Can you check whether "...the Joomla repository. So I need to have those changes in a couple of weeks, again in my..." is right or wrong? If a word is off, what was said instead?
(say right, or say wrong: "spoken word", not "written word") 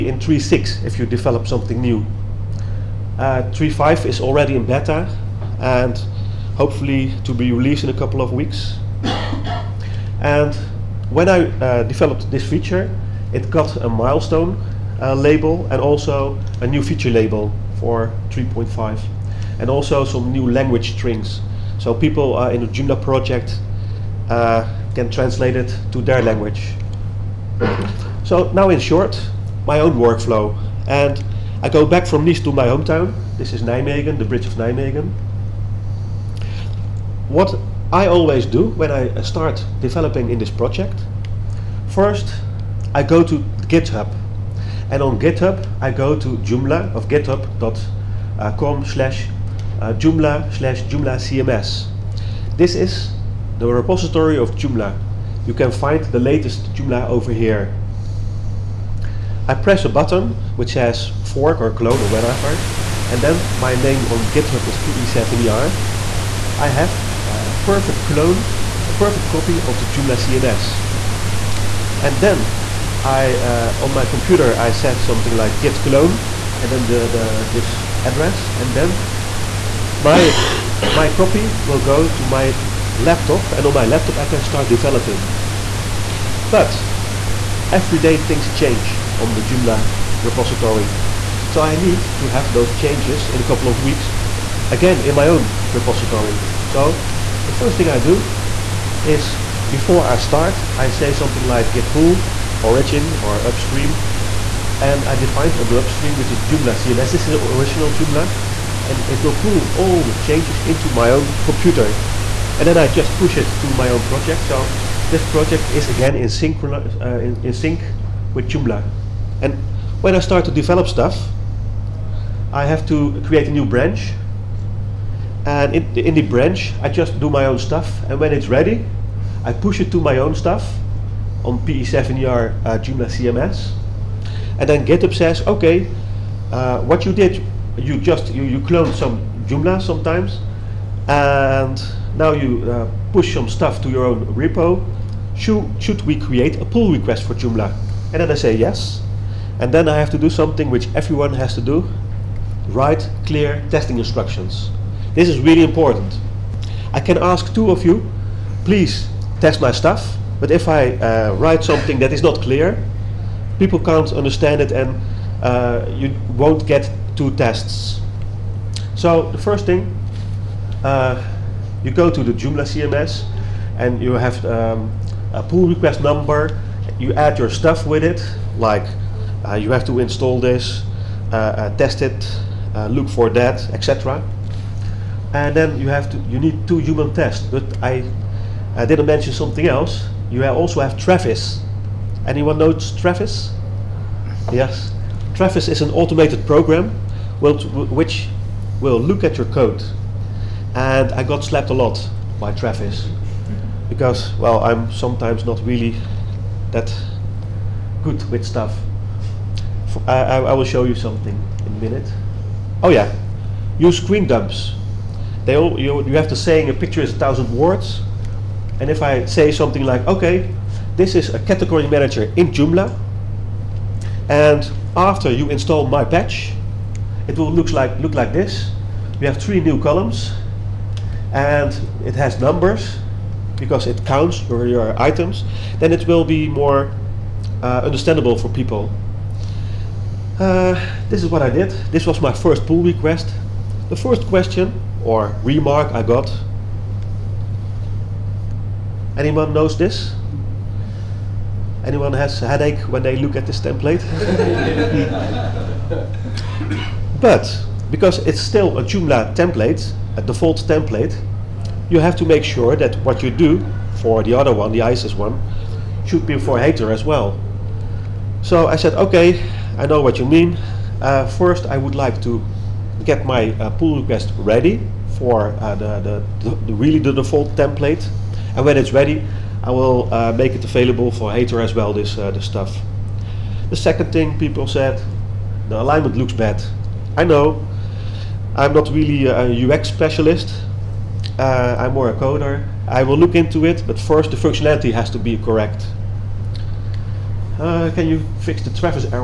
right.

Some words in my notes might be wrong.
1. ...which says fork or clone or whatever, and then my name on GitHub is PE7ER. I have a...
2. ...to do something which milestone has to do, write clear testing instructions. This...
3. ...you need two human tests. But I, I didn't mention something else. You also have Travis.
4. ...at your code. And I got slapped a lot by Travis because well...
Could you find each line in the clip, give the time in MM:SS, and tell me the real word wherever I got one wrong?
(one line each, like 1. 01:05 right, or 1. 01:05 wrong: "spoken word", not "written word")
1. 01:00 right
2. 02:30 wrong: "everyone", not "milestone"
3. 03:06 right
4. 03:19 right.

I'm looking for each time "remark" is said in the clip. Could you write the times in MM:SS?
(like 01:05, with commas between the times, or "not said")
04:05.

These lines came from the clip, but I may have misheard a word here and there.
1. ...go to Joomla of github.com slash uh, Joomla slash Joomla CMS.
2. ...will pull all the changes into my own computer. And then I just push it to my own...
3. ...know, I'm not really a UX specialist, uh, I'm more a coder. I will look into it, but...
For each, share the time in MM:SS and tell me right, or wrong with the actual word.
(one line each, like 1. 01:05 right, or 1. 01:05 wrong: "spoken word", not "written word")
1. 00:45 right
2. 01:49 right
3. 04:47 right.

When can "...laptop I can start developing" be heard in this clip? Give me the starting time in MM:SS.
01:23.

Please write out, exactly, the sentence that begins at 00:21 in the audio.
So people uh, in the Joomla project uh, can translate it to their language.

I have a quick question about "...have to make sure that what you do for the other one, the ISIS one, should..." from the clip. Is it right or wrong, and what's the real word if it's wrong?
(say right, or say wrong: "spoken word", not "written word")
right.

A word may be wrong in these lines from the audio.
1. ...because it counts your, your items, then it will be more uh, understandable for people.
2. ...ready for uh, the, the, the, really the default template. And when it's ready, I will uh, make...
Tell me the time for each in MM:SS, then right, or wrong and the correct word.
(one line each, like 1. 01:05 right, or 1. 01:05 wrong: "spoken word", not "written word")
1. 03:53 right
2. 04:34 right.